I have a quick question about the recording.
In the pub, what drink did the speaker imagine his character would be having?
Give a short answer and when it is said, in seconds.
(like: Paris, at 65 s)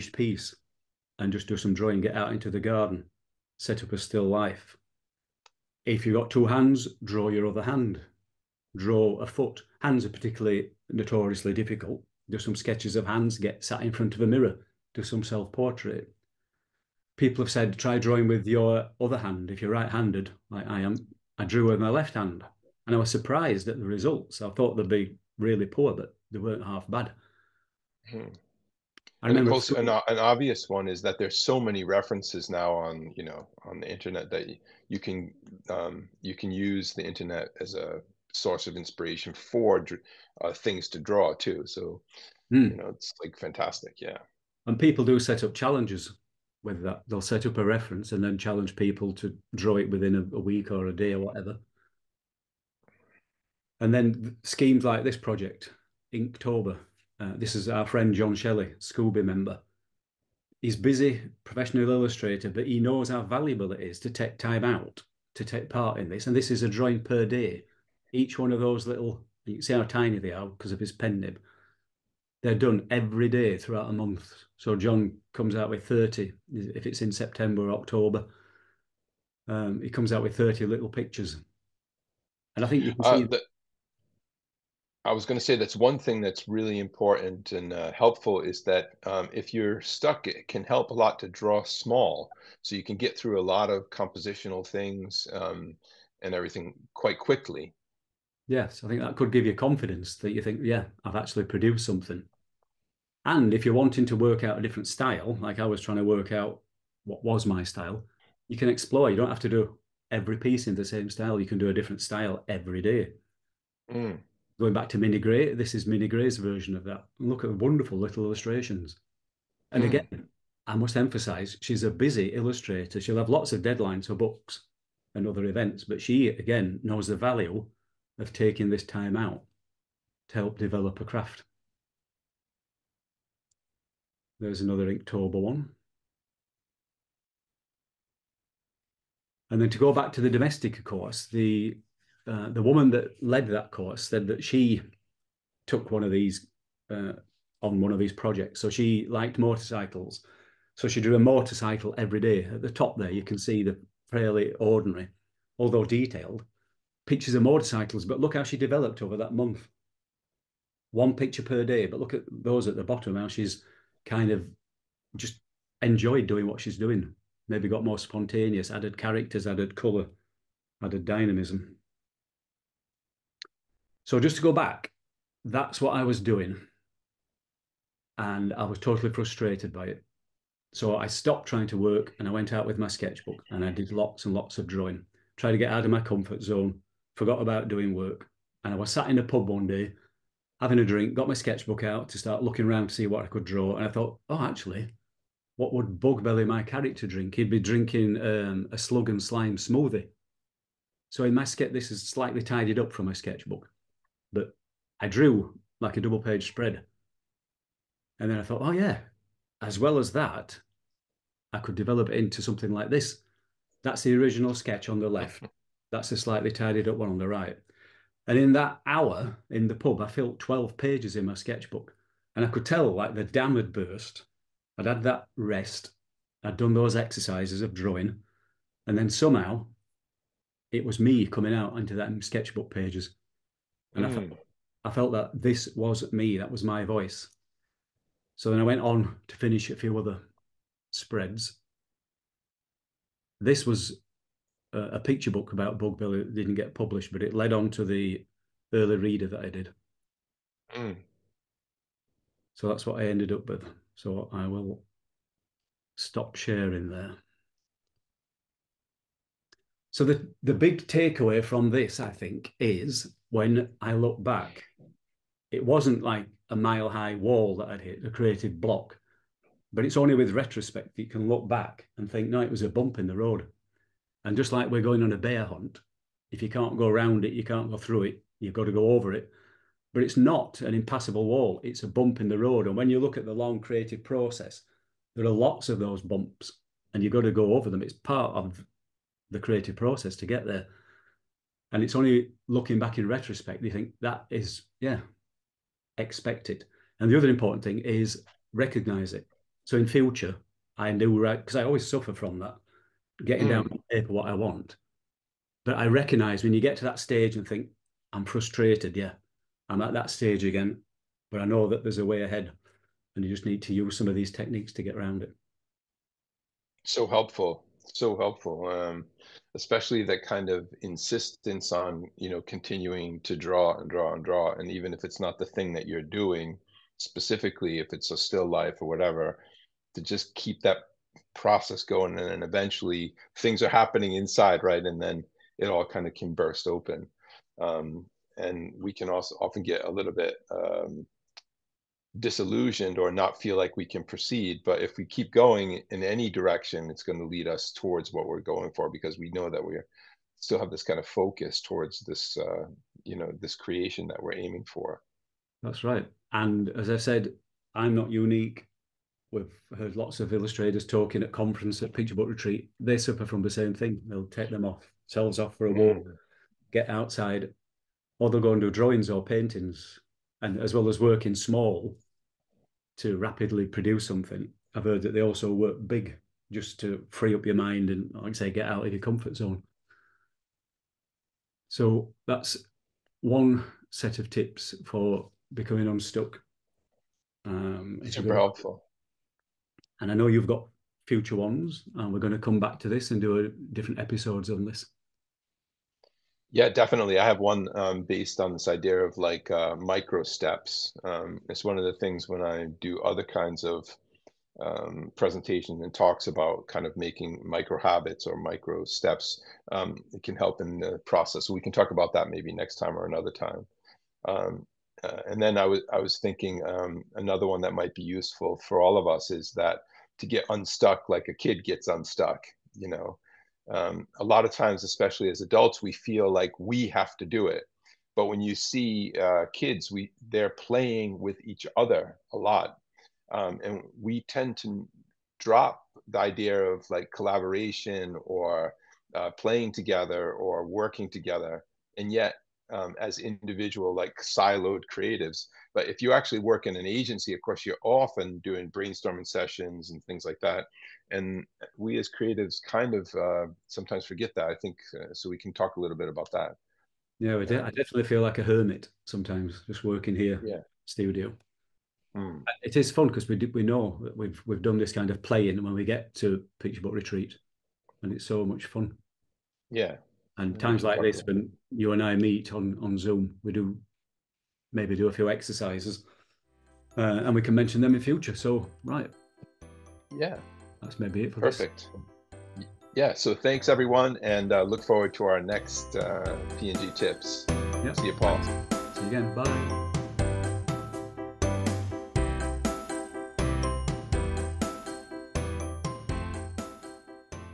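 A slug and slime smoothie, at 198 s.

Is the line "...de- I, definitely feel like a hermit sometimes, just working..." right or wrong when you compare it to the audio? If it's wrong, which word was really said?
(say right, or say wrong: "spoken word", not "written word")
right.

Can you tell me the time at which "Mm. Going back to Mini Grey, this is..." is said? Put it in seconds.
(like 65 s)
113 s.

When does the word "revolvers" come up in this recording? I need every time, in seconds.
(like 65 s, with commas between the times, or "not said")
not said.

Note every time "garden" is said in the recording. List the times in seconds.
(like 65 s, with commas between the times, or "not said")
2 s.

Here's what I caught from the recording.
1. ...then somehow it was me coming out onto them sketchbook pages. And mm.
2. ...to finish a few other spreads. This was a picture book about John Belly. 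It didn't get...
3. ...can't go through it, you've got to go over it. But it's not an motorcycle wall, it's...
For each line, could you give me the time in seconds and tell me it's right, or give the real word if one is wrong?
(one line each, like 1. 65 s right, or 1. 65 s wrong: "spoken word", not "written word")
1. 228 s right
2. 239 s wrong: "Bug", not "John"
3. 277 s wrong: "impassable", not "motorcycle".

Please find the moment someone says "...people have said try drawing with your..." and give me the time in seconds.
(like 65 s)
17 s.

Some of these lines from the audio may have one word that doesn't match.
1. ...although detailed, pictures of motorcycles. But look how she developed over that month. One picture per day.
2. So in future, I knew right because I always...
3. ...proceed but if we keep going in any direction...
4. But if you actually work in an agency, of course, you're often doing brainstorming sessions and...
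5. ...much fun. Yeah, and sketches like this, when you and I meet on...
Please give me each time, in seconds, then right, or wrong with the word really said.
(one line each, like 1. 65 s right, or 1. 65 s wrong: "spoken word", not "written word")
1. 155 s right
2. 299 s right
3. 344 s right
4. 445 s right
5. 468 s wrong: "times", not "sketches".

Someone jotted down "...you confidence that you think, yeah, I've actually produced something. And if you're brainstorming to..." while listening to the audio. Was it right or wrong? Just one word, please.
wrong.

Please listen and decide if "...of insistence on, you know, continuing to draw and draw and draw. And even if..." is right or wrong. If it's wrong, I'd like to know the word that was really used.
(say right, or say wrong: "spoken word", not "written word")
right.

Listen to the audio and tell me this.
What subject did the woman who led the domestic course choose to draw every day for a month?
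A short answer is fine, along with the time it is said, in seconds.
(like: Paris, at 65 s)
A motorcycle, at 151 s.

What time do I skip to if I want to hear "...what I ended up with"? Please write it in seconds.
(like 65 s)
252 s.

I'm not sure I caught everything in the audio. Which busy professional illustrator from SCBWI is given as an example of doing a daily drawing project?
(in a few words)
John Shelley.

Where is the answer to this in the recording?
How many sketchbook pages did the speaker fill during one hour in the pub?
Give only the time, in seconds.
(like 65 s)
220 s.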